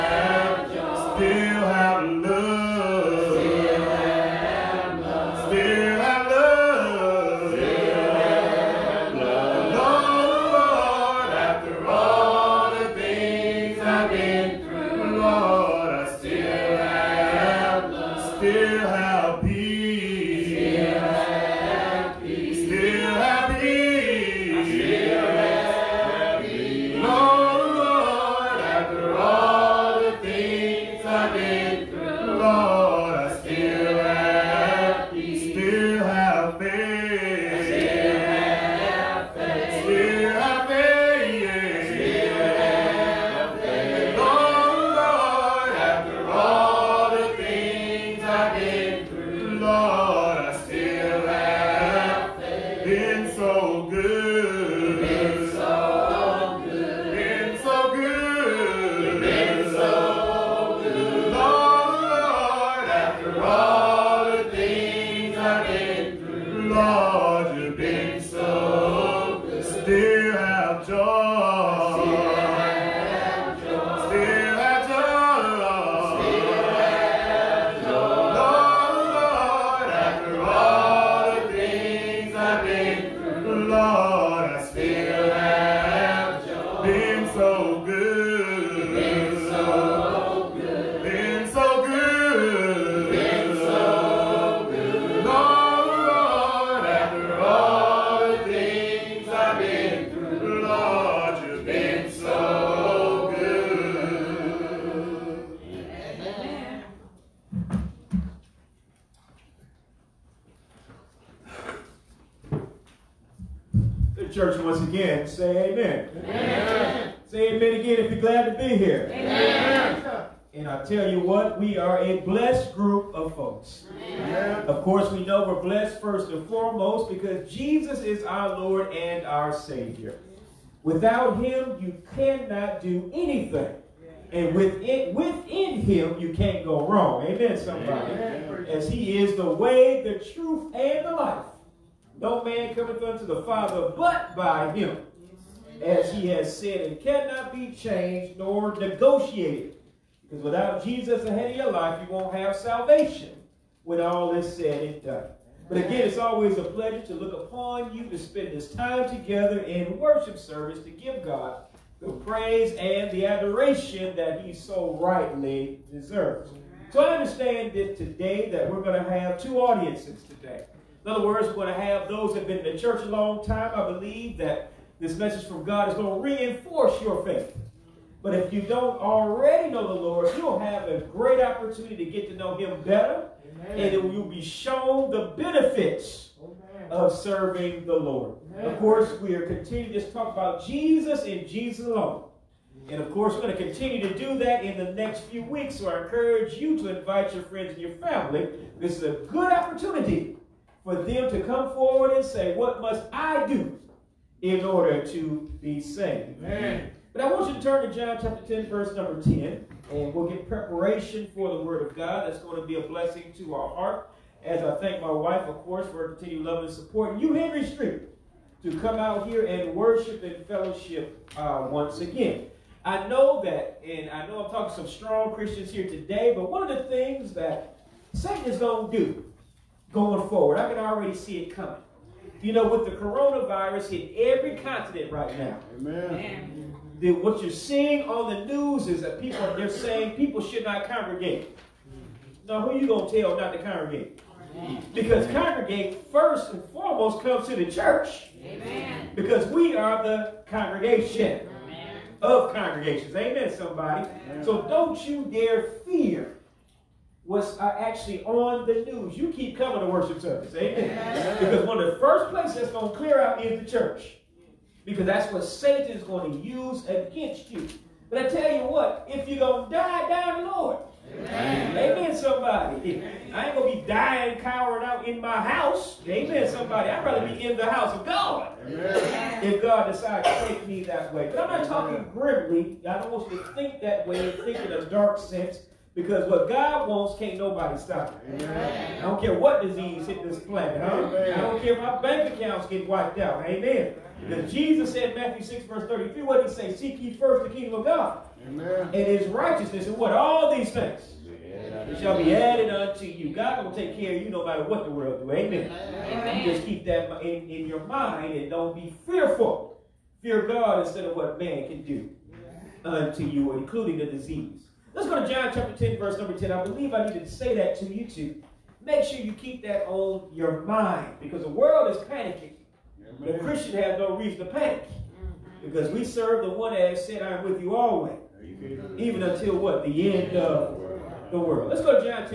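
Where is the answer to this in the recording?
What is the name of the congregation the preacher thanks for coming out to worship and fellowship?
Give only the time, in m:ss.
3:37.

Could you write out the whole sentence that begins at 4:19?
You keep coming to worship service.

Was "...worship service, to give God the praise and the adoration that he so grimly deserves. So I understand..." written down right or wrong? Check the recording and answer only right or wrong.
wrong.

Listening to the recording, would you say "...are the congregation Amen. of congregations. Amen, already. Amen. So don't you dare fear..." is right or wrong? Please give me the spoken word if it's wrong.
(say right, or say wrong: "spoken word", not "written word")
wrong: "somebody", not "already".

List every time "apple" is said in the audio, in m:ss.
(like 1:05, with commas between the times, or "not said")
not said.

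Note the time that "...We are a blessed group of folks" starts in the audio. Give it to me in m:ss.
2:01.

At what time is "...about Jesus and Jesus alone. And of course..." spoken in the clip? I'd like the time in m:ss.
3:10.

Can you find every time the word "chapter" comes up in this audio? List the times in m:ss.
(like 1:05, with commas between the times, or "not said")
3:28, 5:15.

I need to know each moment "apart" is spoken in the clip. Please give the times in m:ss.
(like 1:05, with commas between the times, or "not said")
not said.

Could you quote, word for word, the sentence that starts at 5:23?
The Christian has no reason to panic mm-hmm.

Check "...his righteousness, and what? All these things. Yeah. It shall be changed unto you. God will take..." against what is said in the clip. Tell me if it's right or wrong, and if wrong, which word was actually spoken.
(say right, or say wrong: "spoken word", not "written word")
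wrong: "added", not "changed".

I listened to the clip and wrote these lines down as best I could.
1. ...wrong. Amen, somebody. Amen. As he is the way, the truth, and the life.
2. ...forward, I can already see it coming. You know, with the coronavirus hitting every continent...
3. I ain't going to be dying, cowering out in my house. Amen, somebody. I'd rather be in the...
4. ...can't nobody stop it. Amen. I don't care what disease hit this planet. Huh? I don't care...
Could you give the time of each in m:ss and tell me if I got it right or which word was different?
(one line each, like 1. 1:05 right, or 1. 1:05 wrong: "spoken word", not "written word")
1. 2:16 right
2. 3:50 right
3. 4:33 right
4. 4:47 right.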